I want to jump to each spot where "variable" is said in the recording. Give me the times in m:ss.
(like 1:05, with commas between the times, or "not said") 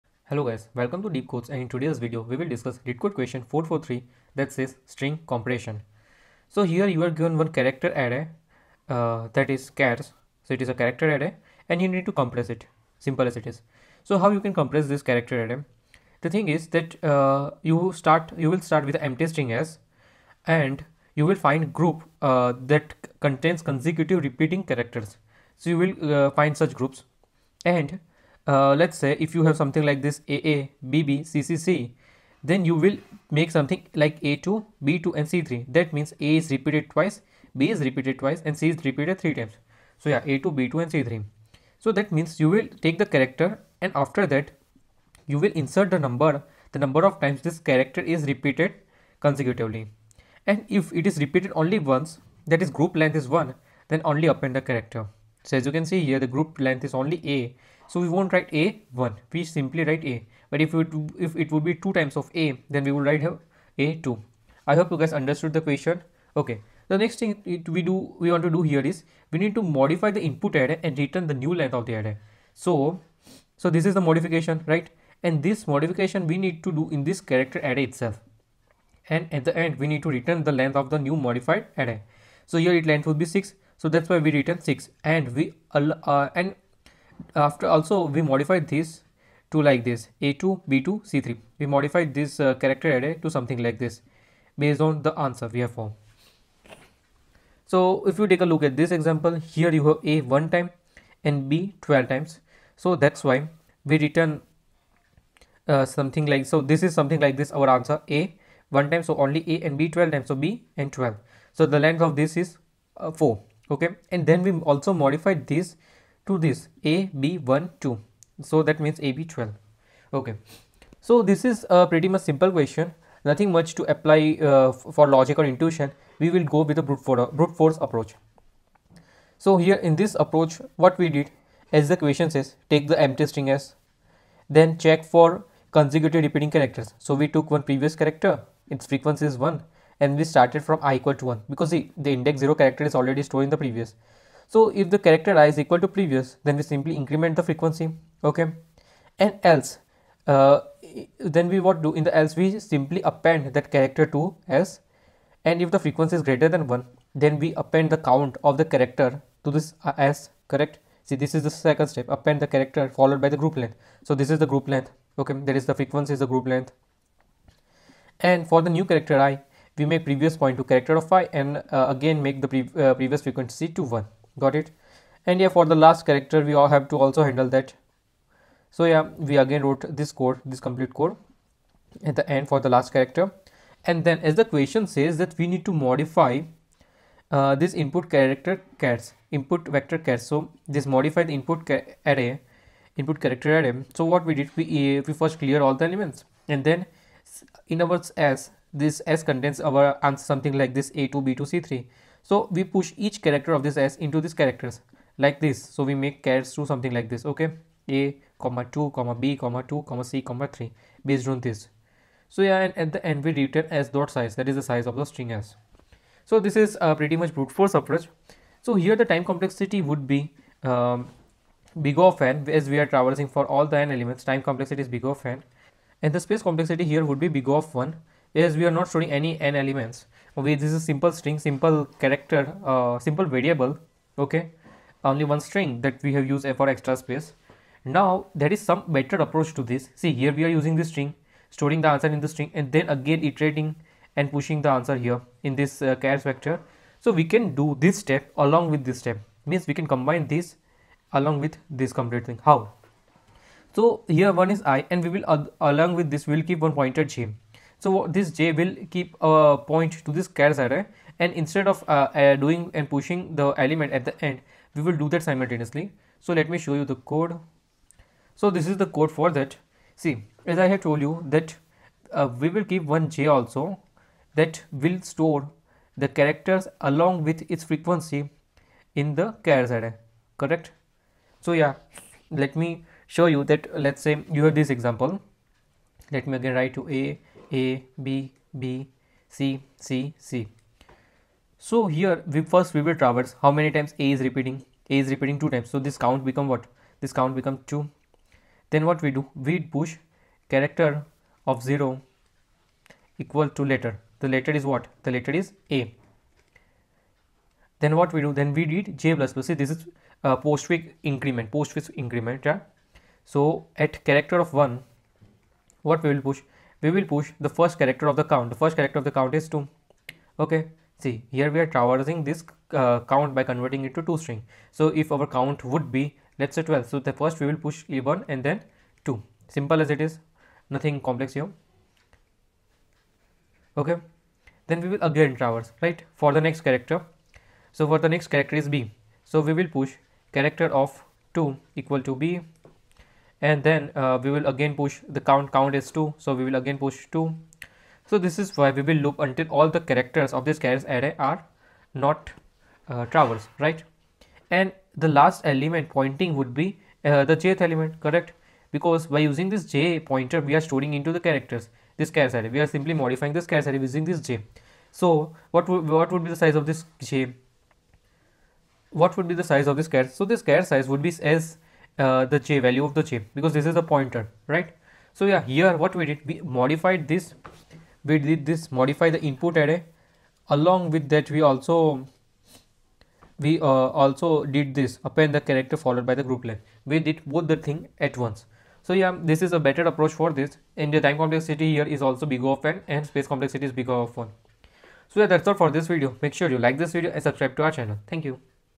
3:53.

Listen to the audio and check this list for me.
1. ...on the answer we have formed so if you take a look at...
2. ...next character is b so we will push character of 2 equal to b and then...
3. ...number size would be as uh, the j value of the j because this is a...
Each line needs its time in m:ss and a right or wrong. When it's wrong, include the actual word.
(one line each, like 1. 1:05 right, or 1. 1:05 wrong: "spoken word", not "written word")
1. 1:34 right
2. 5:38 right
3. 6:10 wrong: "character", not "number".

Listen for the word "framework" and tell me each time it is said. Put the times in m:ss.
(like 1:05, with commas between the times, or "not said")
not said.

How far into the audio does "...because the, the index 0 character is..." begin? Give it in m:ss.
2:21.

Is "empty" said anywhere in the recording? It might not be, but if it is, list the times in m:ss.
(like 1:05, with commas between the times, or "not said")
0:19, 2:13.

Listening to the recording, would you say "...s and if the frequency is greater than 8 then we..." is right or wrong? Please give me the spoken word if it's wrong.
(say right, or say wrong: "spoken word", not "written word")
wrong: "1", not "8".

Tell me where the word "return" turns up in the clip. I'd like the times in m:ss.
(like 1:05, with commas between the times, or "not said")
1:10, 1:20, 1:24, 1:44, 3:33.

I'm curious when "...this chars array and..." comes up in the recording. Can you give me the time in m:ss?
4:20.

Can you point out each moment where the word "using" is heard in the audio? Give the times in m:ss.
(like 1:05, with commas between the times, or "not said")
4:00, 5:59, 6:03.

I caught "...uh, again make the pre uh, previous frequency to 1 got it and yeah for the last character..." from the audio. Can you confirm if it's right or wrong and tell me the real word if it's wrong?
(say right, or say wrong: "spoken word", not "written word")
right.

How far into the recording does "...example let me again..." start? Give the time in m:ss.
4:44.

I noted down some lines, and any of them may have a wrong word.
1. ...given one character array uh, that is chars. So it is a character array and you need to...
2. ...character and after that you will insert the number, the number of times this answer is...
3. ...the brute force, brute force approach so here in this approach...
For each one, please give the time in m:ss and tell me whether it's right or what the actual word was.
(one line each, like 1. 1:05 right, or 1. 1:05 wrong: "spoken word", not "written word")
1. 0:07 right
2. 0:43 wrong: "character", not "answer"
3. 2:06 right.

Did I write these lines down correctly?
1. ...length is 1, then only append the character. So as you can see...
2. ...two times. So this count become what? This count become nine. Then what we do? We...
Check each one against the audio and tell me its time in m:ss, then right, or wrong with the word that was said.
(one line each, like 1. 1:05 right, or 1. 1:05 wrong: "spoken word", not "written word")
1. 0:52 right
2. 4:55 wrong: "two", not "nine".